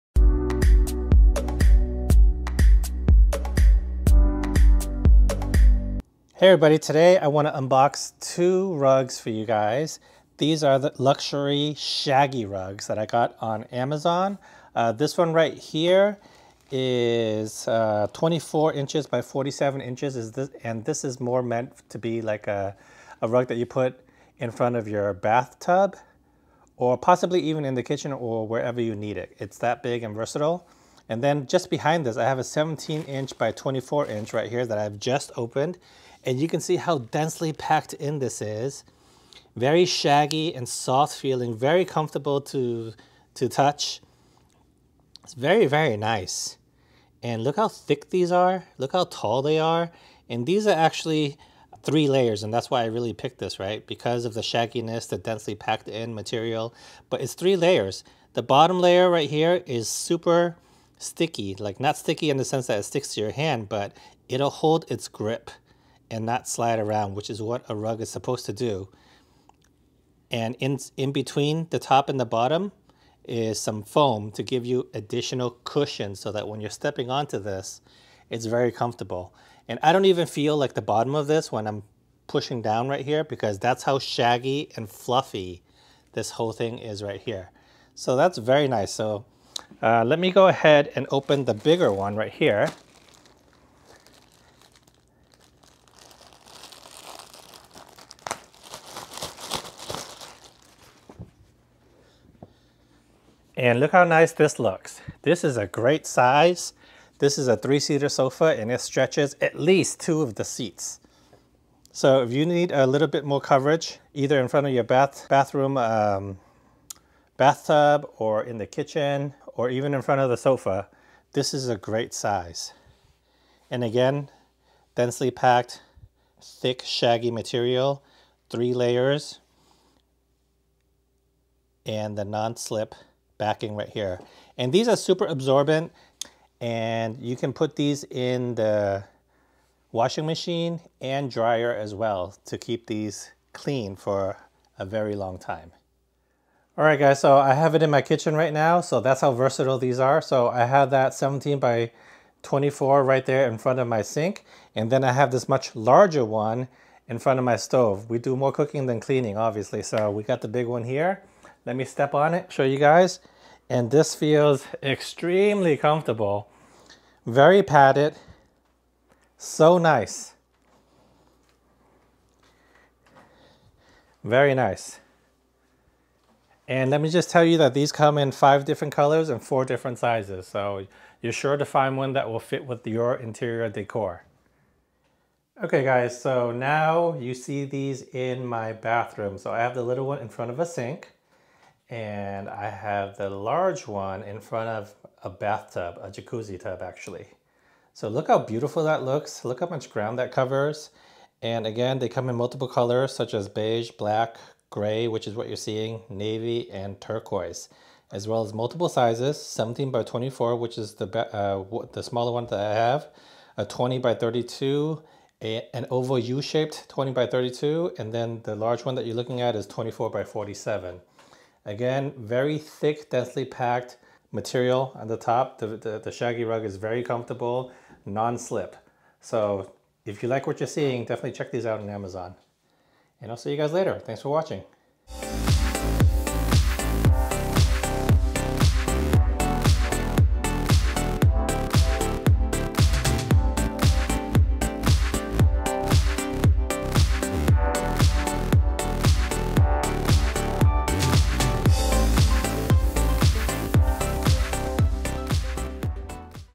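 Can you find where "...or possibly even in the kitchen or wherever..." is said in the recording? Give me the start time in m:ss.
0:26.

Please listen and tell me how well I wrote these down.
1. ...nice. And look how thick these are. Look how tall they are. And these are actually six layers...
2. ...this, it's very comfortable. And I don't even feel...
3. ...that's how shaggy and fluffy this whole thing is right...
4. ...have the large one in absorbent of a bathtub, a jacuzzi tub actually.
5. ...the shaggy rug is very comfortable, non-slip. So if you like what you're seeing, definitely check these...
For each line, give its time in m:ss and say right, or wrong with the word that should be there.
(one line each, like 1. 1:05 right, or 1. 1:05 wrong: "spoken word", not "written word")
1. 0:45 wrong: "three", not "six"
2. 1:17 right
3. 1:23 right
4. 3:12 wrong: "front", not "absorbent"
5. 3:45 right.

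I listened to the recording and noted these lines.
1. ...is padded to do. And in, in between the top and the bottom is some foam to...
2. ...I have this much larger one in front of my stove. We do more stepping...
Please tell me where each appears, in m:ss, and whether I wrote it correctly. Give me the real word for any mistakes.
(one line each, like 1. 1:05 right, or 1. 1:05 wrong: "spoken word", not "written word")
1. 1:08 wrong: "supposed", not "padded"
2. 2:35 wrong: "cooking", not "stepping".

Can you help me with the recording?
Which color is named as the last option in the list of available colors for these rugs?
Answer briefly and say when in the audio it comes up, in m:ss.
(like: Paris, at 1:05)
turquoise, at 3:27.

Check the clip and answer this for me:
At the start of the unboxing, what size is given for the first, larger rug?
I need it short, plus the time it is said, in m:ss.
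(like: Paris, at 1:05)
24 inches by 47 inches, at 0:18.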